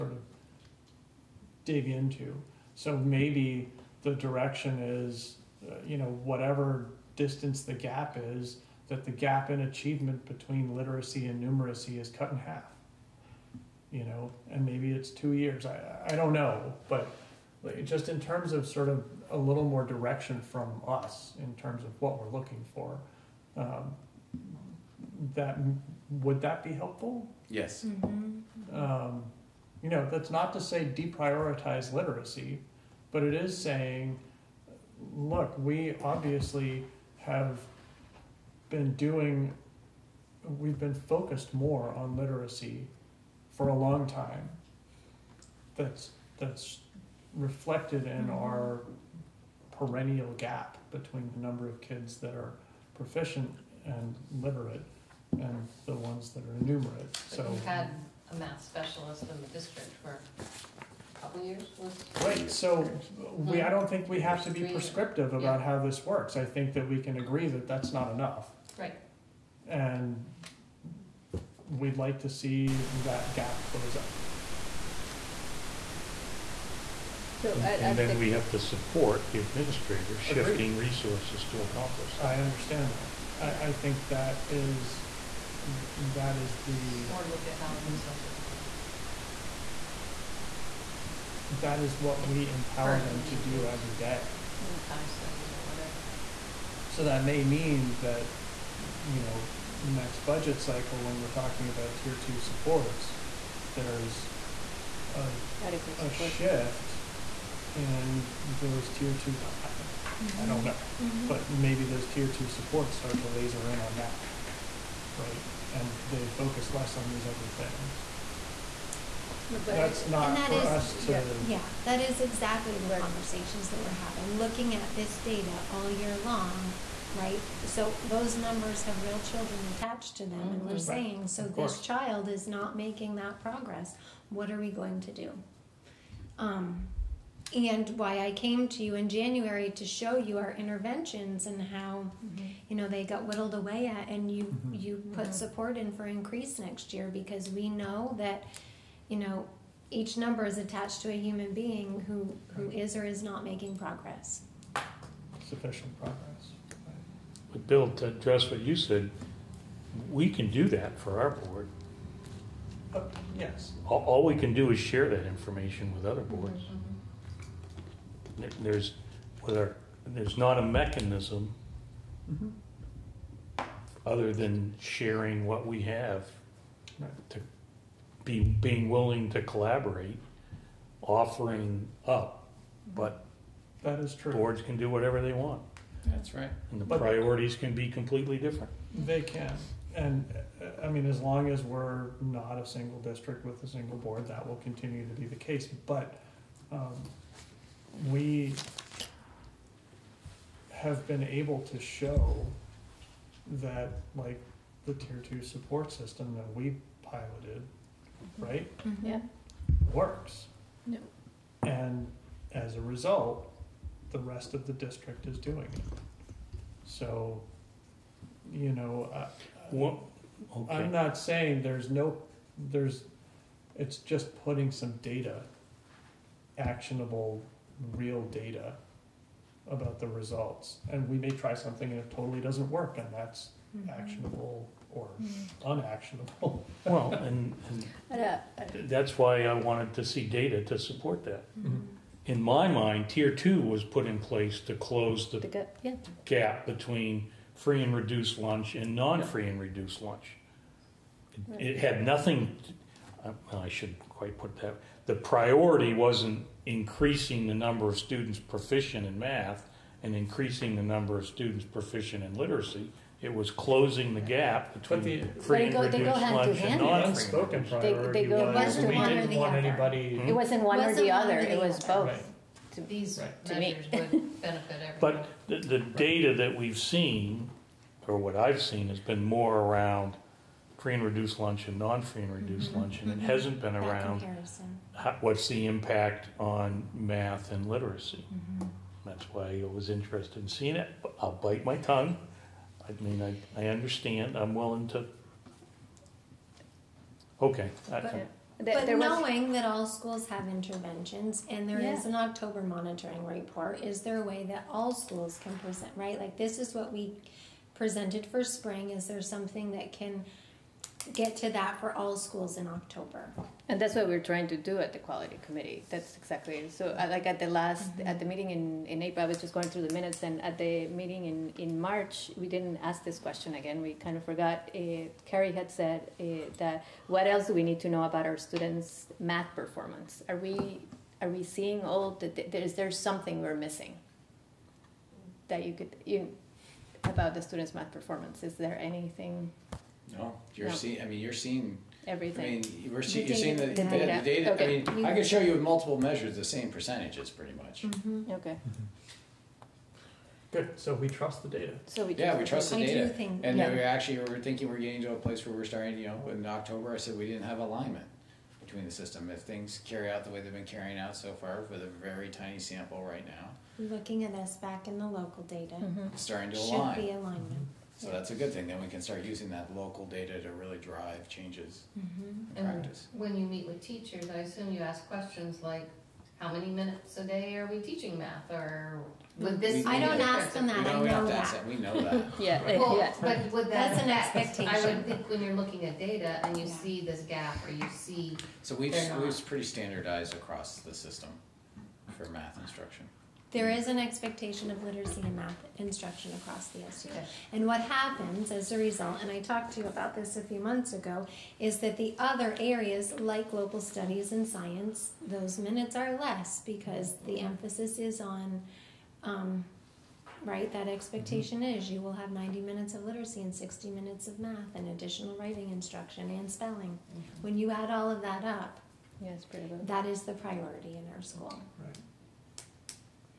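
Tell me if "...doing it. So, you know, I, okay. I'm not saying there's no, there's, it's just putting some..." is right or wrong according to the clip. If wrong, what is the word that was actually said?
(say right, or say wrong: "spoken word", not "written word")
right.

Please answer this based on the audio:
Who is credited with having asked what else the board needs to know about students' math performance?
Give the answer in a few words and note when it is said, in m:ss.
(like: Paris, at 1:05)
Carrie, at 5:25.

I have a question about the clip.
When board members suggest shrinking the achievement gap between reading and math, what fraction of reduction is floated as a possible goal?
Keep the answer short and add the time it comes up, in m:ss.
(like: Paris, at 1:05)
cut in half, at 0:12.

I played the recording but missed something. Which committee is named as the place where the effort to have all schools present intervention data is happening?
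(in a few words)
quality committee.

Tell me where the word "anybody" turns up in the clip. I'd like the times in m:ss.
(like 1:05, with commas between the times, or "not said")
4:29.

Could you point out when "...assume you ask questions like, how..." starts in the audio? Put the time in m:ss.
6:14.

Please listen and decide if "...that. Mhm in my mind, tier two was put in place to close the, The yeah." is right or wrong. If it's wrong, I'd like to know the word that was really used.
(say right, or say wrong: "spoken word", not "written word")
right.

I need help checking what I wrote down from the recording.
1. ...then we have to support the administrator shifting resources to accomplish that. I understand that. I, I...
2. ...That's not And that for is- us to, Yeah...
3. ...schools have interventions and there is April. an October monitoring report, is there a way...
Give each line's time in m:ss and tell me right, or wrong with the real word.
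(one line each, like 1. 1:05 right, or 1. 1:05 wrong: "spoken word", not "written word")
1. 1:17 right
2. 1:59 right
3. 4:59 wrong: "Yeah", not "April".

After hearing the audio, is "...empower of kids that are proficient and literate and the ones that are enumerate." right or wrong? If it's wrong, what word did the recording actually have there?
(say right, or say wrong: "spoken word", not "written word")
wrong: "number", not "empower".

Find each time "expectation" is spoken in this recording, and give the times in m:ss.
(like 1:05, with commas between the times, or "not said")
6:24, 6:33, 6:50.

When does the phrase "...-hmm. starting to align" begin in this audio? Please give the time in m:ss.
6:05.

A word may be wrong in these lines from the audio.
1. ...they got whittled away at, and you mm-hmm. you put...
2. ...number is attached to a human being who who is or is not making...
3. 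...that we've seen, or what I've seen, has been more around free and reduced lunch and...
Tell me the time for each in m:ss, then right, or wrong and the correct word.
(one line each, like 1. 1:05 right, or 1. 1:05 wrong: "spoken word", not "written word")
1. 2:22 right
2. 2:30 right
3. 4:36 right.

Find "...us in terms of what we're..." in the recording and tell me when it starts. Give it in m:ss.
0:20.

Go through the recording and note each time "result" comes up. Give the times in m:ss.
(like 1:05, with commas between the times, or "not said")
3:32, 3:50, 6:38.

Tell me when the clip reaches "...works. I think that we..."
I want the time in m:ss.
1:06.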